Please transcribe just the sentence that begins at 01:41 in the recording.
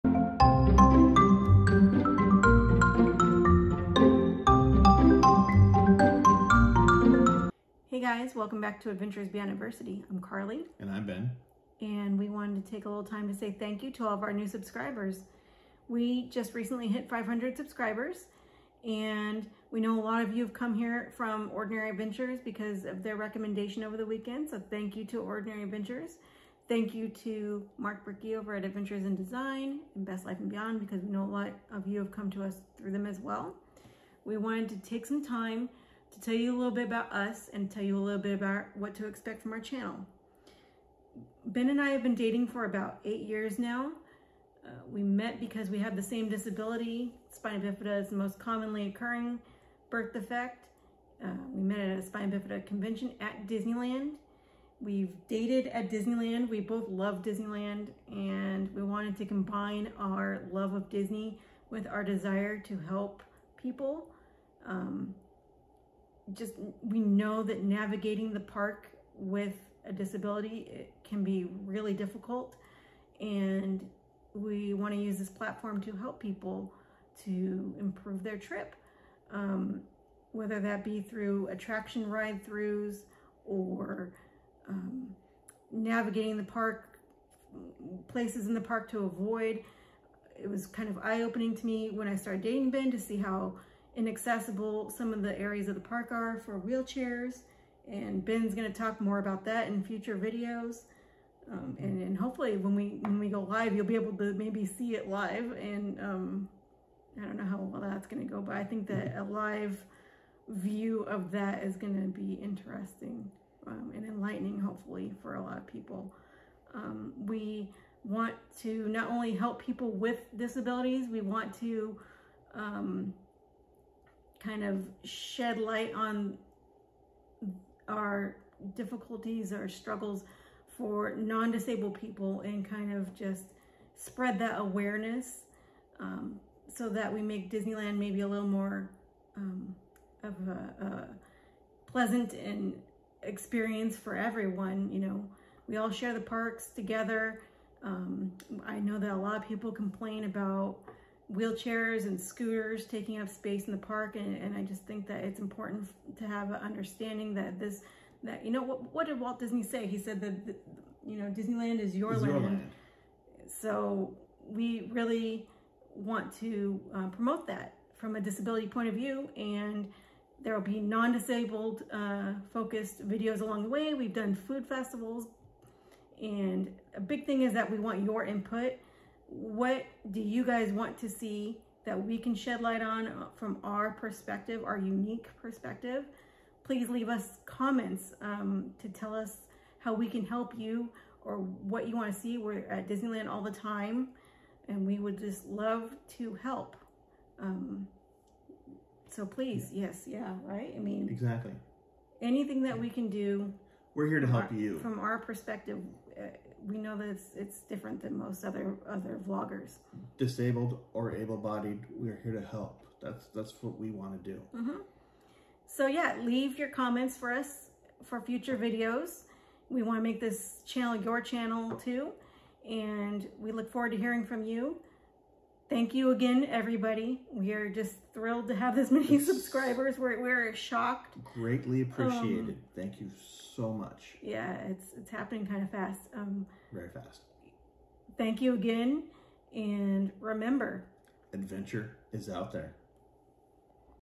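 Um, and, and, hopefully when we when we go live, you'll be able to maybe see it live.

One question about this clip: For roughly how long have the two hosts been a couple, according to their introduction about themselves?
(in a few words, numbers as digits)
About 8 years.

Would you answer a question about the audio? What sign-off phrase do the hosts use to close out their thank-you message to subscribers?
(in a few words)
Adventure is out there.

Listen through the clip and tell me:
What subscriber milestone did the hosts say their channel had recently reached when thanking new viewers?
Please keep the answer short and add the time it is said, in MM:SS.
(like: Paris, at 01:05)
500, at 00:17.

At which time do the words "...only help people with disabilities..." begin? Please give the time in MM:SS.
01:59.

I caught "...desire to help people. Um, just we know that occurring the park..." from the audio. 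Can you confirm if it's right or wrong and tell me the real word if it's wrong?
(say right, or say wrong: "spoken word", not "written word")
wrong: "navigating", not "occurring".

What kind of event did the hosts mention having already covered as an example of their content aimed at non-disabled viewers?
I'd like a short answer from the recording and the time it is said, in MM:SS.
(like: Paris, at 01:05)
Food festivals, at 02:54.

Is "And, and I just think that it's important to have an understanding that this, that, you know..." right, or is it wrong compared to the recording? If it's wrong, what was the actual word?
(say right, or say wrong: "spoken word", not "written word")
right.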